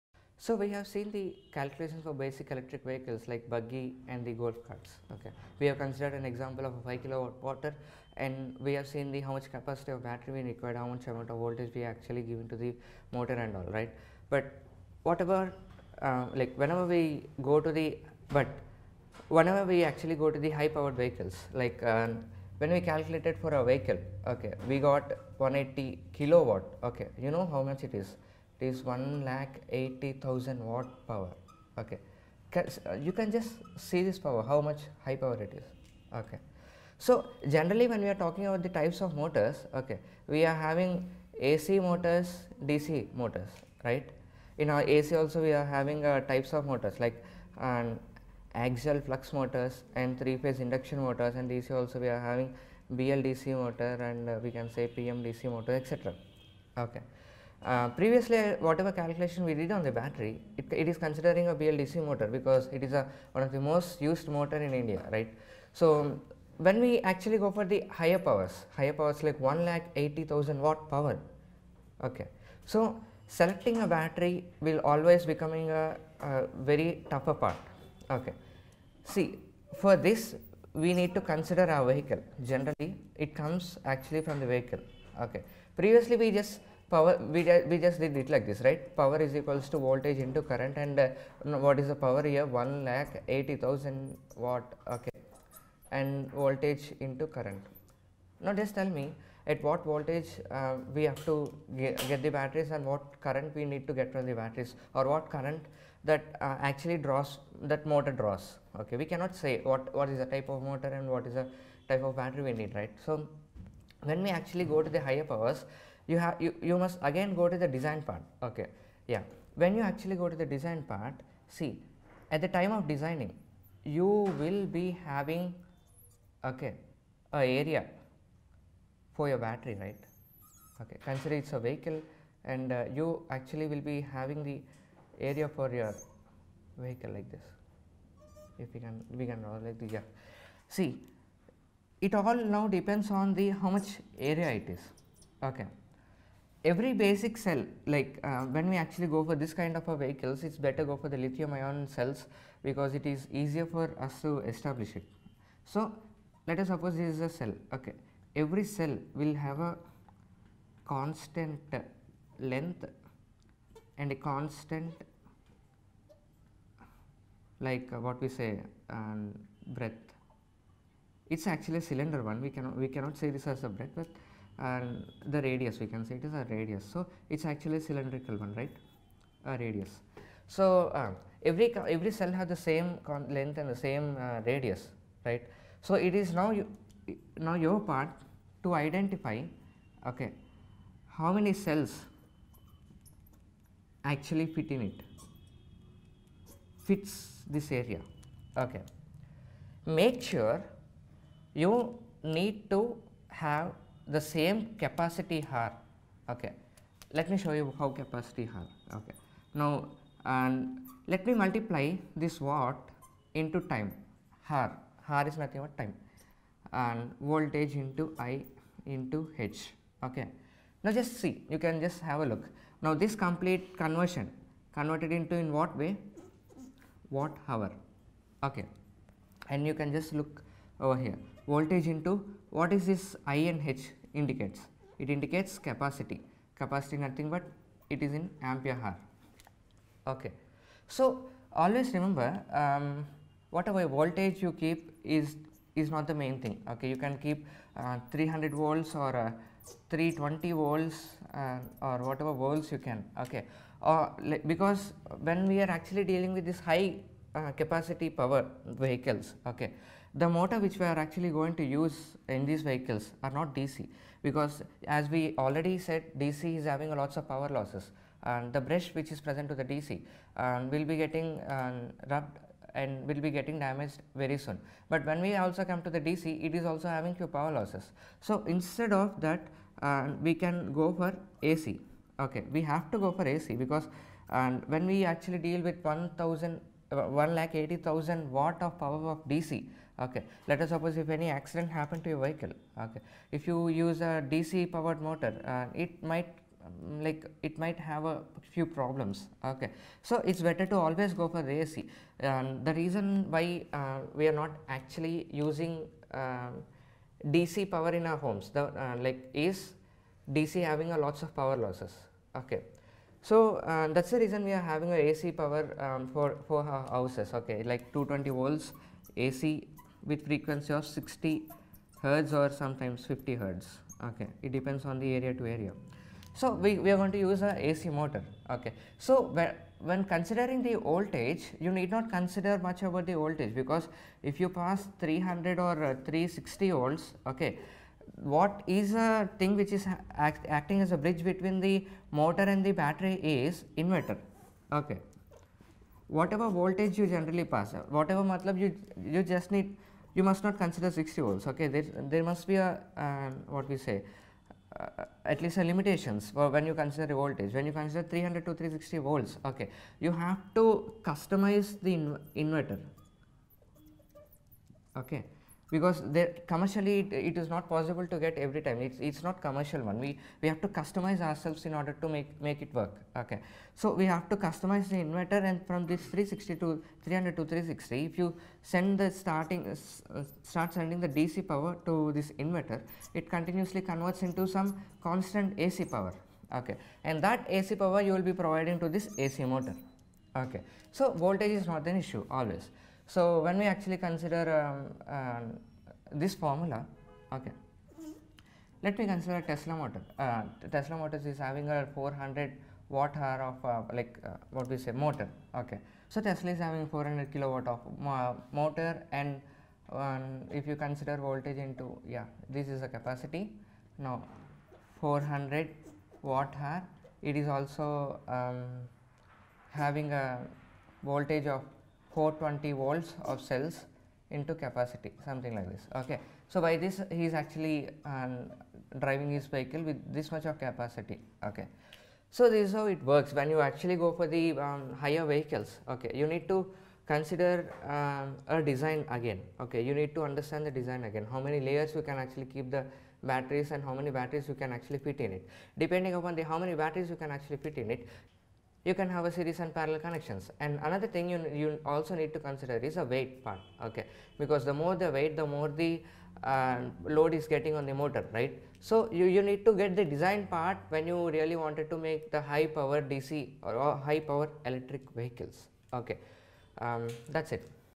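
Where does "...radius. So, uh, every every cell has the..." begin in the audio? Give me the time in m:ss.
2:59.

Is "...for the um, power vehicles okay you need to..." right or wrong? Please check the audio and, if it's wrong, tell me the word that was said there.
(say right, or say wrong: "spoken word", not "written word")
wrong: "higher", not "power".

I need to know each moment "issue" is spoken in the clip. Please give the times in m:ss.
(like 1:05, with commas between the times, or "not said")
6:31.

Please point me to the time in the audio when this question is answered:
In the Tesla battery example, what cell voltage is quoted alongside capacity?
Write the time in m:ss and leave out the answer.
7:02.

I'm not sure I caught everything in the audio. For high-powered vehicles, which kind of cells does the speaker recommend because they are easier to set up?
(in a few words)
lithium ion cells.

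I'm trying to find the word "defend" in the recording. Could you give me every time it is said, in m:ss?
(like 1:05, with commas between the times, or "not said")
not said.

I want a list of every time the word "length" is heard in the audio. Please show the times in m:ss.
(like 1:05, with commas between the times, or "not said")
2:42, 3:03.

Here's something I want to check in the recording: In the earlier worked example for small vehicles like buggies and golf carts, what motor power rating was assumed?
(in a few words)
5 kilowatt.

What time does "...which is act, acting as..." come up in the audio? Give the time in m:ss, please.
5:39.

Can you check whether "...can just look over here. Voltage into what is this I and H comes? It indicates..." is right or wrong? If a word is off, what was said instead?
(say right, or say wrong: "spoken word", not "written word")
wrong: "indicates", not "comes".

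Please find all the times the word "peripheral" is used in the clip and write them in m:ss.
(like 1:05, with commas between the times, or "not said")
not said.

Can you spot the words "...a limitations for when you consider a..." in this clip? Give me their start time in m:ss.
5:55.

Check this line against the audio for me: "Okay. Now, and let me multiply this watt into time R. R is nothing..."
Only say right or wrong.
right.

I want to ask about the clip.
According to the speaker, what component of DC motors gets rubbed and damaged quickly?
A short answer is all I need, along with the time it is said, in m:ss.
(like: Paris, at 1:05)
the brush, at 4:28.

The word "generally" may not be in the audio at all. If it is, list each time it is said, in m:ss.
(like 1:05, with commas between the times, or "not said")
0:37, 1:22, 5:47.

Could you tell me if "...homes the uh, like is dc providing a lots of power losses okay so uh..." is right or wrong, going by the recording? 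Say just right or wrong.
wrong.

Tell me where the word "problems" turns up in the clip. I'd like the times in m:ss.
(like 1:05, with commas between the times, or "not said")
4:58.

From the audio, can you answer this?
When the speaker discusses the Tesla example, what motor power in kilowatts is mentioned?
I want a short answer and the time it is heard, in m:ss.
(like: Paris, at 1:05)
400 kilowatt, at 6:46.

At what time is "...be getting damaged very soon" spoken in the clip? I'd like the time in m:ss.
4:33.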